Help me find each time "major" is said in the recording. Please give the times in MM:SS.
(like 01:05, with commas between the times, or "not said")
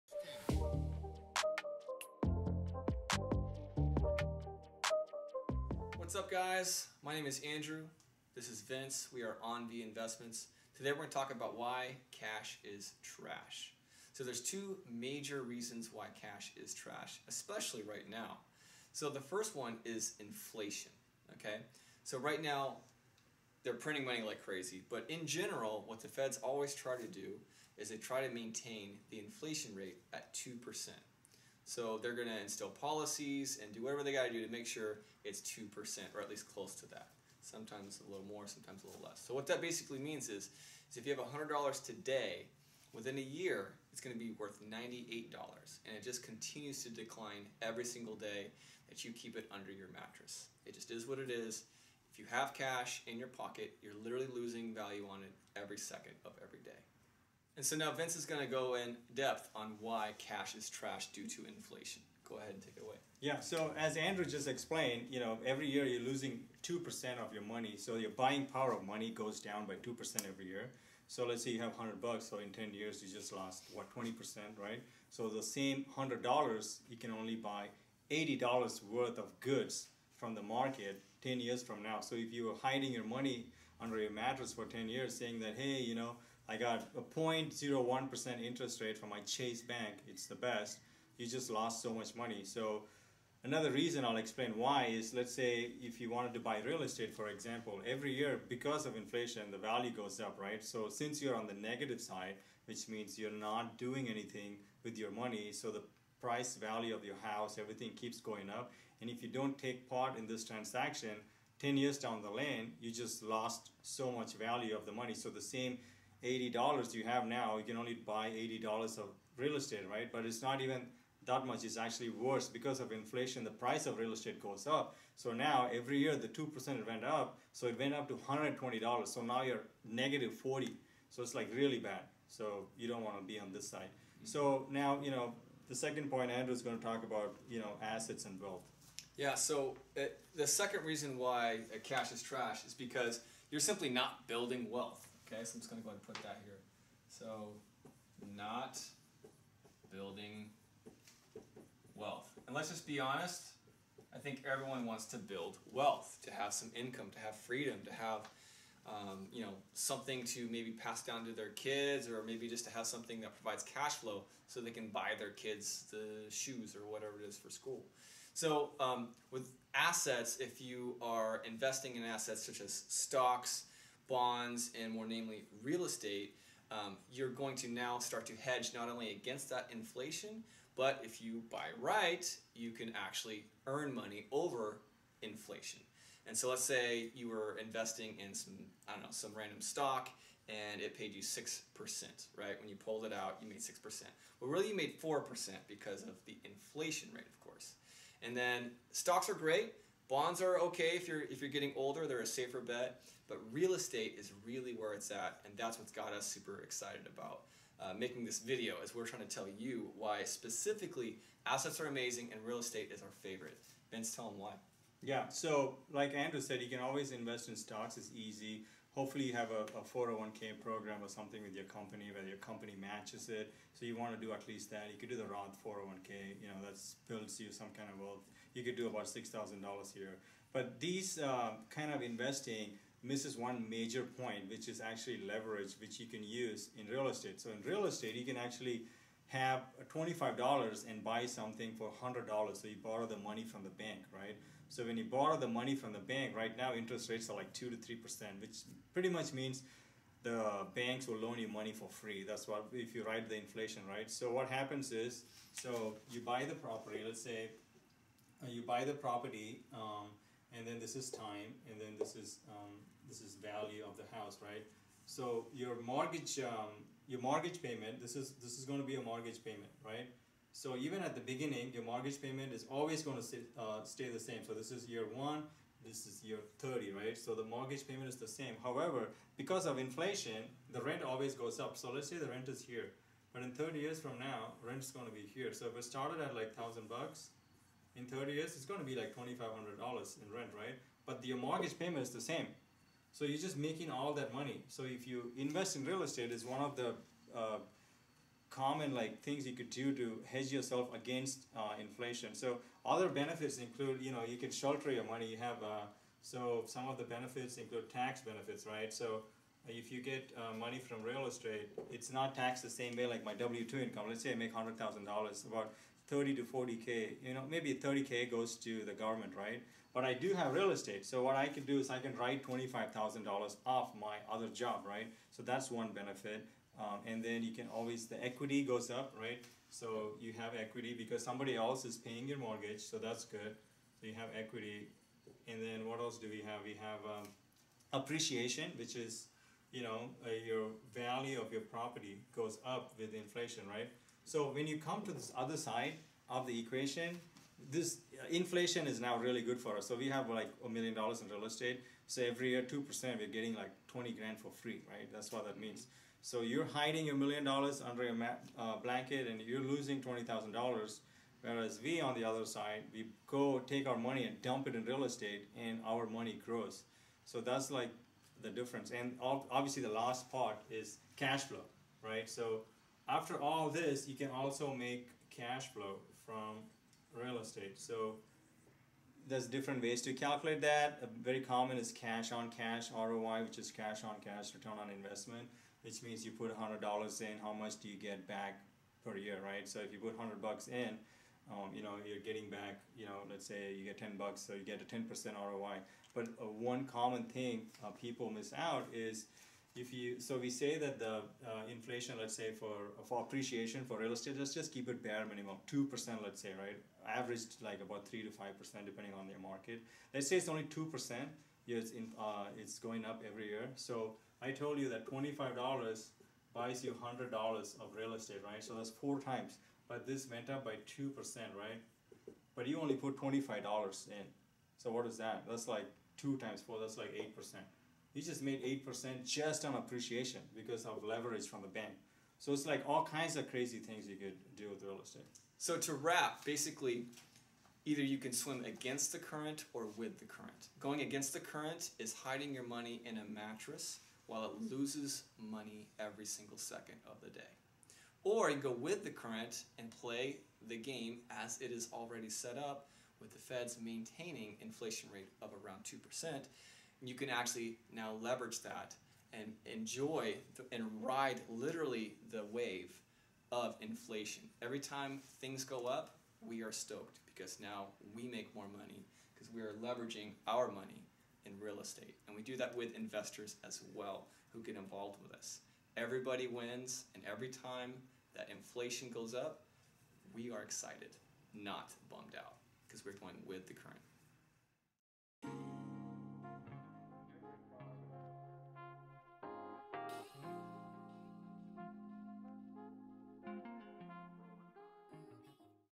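00:14, 03:53.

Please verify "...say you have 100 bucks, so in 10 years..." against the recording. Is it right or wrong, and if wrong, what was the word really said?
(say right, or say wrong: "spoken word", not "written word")
right.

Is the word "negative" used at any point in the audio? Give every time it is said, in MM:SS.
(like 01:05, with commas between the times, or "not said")
01:41, 02:09.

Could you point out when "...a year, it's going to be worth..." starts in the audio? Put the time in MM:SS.
00:43.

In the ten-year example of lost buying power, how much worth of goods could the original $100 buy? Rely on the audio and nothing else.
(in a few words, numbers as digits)
$80.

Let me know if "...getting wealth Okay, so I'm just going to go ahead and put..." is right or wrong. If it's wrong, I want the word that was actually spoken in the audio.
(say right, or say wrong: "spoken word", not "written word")
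wrong: "building", not "getting".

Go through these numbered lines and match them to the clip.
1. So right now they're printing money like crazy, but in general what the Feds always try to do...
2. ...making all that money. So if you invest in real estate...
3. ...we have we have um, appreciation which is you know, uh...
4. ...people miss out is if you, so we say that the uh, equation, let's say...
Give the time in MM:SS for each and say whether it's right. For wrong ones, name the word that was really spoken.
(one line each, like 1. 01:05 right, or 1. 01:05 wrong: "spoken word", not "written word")
1. 00:22 right
2. 04:53 right
3. 05:36 right
4. 06:37 wrong: "inflation", not "equation".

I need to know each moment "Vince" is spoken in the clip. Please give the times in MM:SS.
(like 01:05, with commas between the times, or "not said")
00:08, 00:57, 03:33.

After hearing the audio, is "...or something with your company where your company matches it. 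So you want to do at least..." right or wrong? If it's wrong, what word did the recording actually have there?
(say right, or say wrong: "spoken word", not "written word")
right.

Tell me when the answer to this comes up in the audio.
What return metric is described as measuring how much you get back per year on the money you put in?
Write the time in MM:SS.
06:21.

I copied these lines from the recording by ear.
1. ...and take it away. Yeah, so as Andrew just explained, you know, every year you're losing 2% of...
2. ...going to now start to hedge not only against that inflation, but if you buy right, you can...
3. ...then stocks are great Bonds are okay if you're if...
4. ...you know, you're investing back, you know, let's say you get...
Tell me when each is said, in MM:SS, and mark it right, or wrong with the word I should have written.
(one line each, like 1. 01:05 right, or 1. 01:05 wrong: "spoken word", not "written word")
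1. 01:02 right
2. 02:57 right
3. 03:18 right
4. 06:31 wrong: "getting", not "investing".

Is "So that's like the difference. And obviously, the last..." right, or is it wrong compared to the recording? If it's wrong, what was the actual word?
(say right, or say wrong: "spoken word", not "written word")
right.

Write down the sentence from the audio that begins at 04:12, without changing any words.
That's what, if you write the inflation, right?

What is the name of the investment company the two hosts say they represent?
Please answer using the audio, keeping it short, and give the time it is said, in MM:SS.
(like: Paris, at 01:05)
AnVi Investments, at 00:09.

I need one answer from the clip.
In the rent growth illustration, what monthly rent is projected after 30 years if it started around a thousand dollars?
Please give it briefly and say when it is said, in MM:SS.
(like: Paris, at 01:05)
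$2,500, at 04:49.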